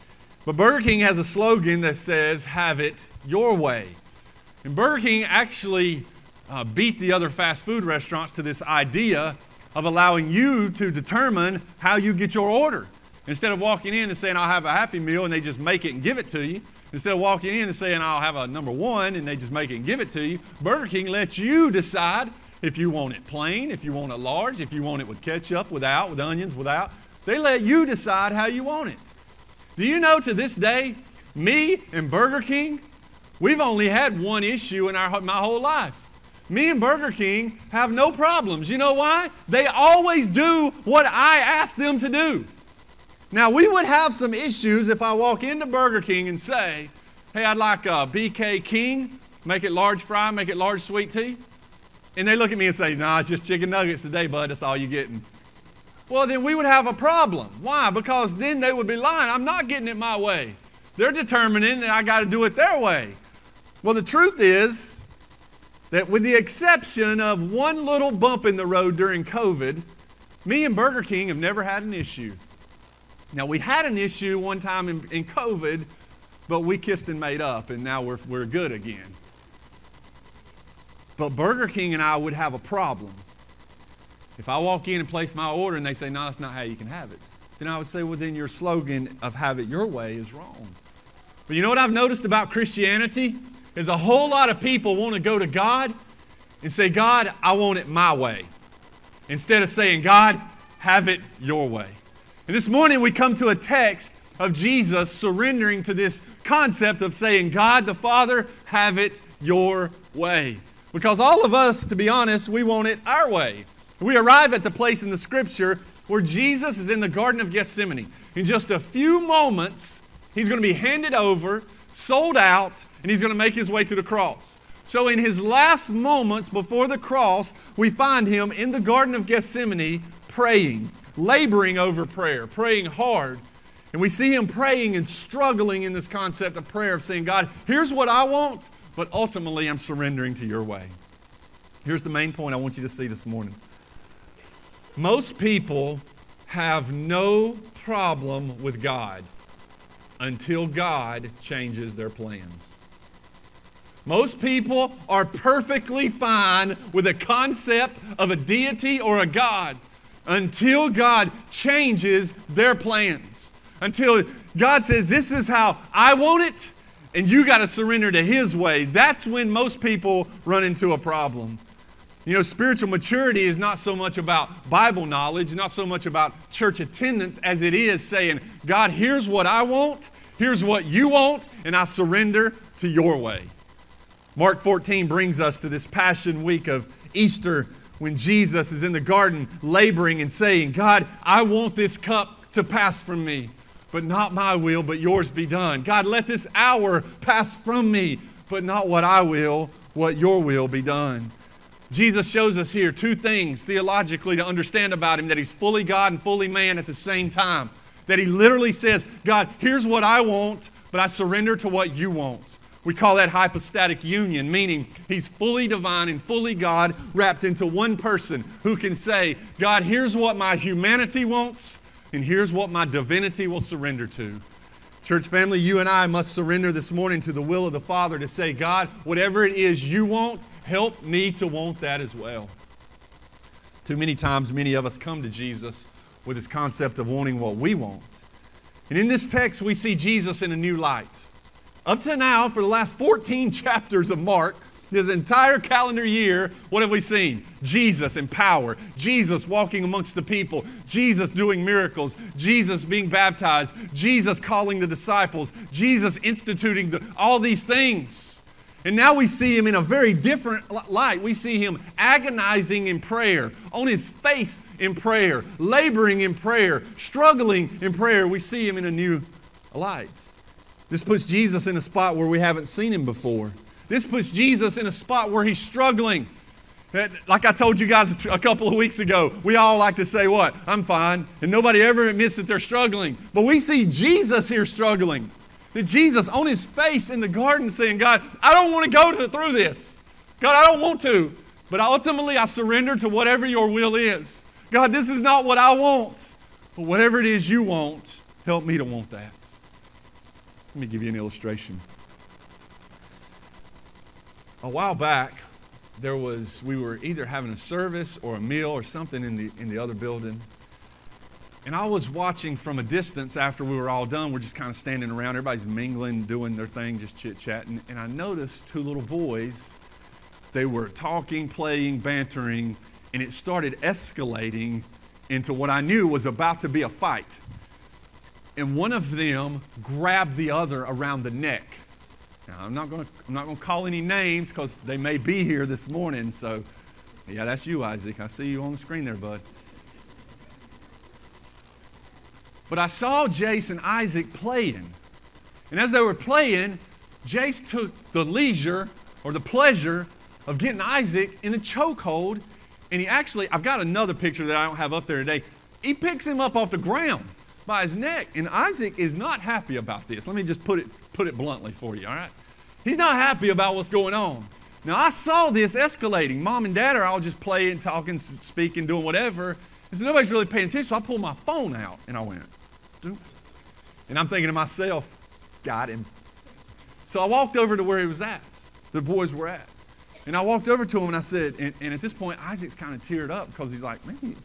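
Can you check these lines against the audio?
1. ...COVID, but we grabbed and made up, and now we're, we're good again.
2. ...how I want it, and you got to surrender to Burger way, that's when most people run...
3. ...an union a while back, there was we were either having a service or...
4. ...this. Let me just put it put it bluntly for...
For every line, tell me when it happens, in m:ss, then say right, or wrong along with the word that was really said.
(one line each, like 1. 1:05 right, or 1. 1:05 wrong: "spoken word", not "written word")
1. 1:15 wrong: "kissed", not "grabbed"
2. 2:45 wrong: "His", not "Burger"
3. 5:01 wrong: "illustration", not "union"
4. 6:00 right.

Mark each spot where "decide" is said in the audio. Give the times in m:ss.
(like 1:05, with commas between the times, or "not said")
0:21, 0:27.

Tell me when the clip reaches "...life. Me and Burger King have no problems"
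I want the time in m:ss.
0:35.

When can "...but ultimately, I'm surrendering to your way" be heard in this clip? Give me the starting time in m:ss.
2:18.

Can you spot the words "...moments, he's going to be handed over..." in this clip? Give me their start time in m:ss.
1:59.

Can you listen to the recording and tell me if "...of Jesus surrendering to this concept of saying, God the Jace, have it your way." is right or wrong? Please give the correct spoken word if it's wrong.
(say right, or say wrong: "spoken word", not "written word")
wrong: "Father", not "Jace".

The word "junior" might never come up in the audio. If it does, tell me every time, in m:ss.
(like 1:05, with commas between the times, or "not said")
not said.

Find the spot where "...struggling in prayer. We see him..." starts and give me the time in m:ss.
4:26.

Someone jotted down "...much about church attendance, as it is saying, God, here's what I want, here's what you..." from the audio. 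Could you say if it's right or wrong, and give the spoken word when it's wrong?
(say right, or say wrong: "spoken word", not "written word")
right.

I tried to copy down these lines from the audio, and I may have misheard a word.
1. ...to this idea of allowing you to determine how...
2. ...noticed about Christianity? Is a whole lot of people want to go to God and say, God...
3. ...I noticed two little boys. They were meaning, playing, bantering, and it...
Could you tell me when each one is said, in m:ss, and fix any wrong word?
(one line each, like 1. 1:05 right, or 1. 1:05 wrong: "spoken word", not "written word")
1. 0:08 right
2. 1:31 right
3. 5:17 wrong: "talking", not "meaning".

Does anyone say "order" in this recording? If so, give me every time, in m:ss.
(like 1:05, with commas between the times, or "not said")
0:12, 1:25.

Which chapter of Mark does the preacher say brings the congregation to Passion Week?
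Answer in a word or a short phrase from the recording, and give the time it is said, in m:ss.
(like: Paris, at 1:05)
14, at 3:04.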